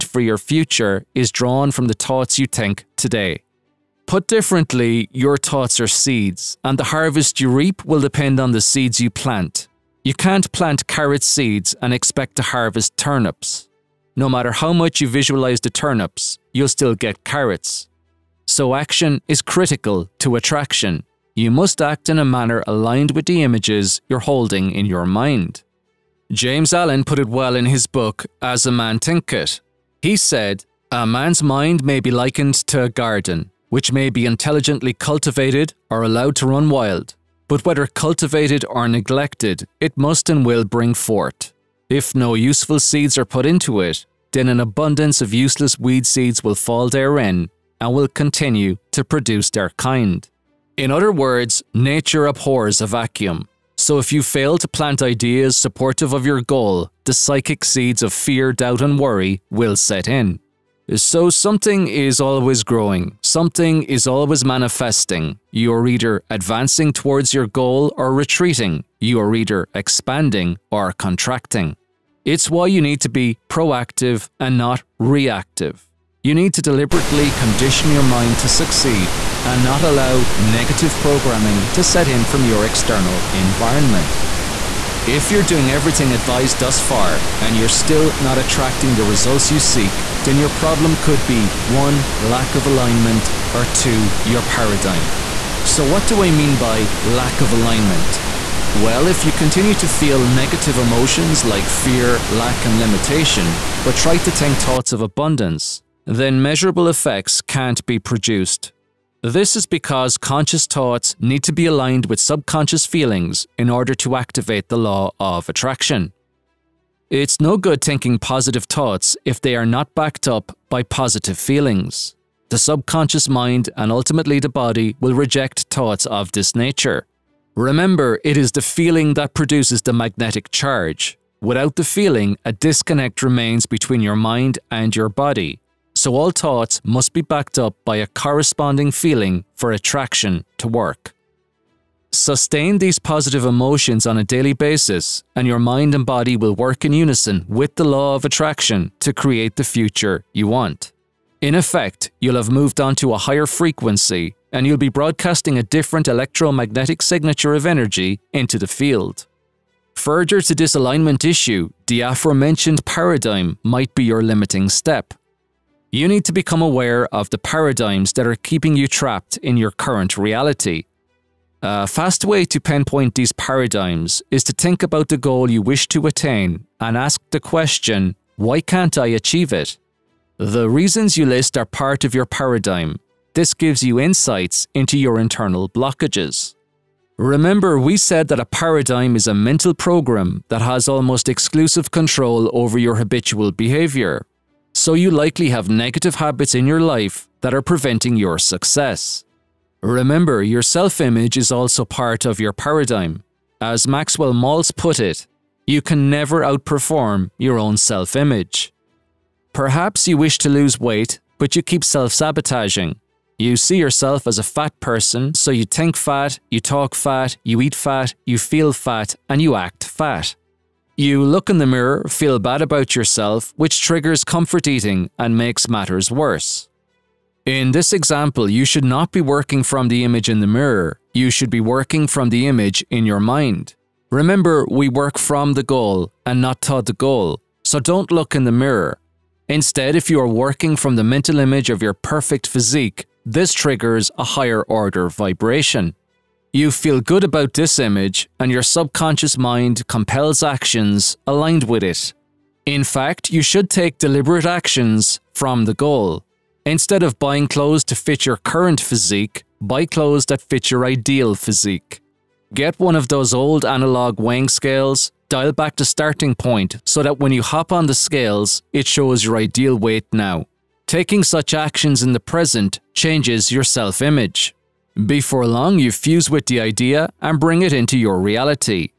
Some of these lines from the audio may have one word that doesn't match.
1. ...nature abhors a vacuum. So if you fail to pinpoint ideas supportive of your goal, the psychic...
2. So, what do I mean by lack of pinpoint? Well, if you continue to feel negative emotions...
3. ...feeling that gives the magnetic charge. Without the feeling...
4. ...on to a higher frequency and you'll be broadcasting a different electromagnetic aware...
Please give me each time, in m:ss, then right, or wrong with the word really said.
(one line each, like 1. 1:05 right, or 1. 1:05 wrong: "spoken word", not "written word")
1. 0:51 wrong: "plant", not "pinpoint"
2. 1:35 wrong: "alignment", not "pinpoint"
3. 2:08 wrong: "produces", not "gives"
4. 2:32 wrong: "signature", not "aware".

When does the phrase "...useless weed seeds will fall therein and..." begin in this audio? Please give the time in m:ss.
0:45.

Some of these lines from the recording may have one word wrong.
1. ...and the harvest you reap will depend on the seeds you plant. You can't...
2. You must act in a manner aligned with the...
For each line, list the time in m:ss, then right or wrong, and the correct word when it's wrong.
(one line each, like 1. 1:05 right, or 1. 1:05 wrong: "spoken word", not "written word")
1. 0:06 right
2. 0:21 right.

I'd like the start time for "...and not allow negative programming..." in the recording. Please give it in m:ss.
1:19.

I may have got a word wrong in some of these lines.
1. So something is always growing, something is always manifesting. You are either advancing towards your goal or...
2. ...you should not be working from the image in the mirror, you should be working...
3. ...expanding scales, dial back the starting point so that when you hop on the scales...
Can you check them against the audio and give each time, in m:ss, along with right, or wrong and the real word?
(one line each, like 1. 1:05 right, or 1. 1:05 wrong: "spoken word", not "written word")
1. 1:00 right
2. 3:48 right
3. 4:24 wrong: "weighing", not "expanding".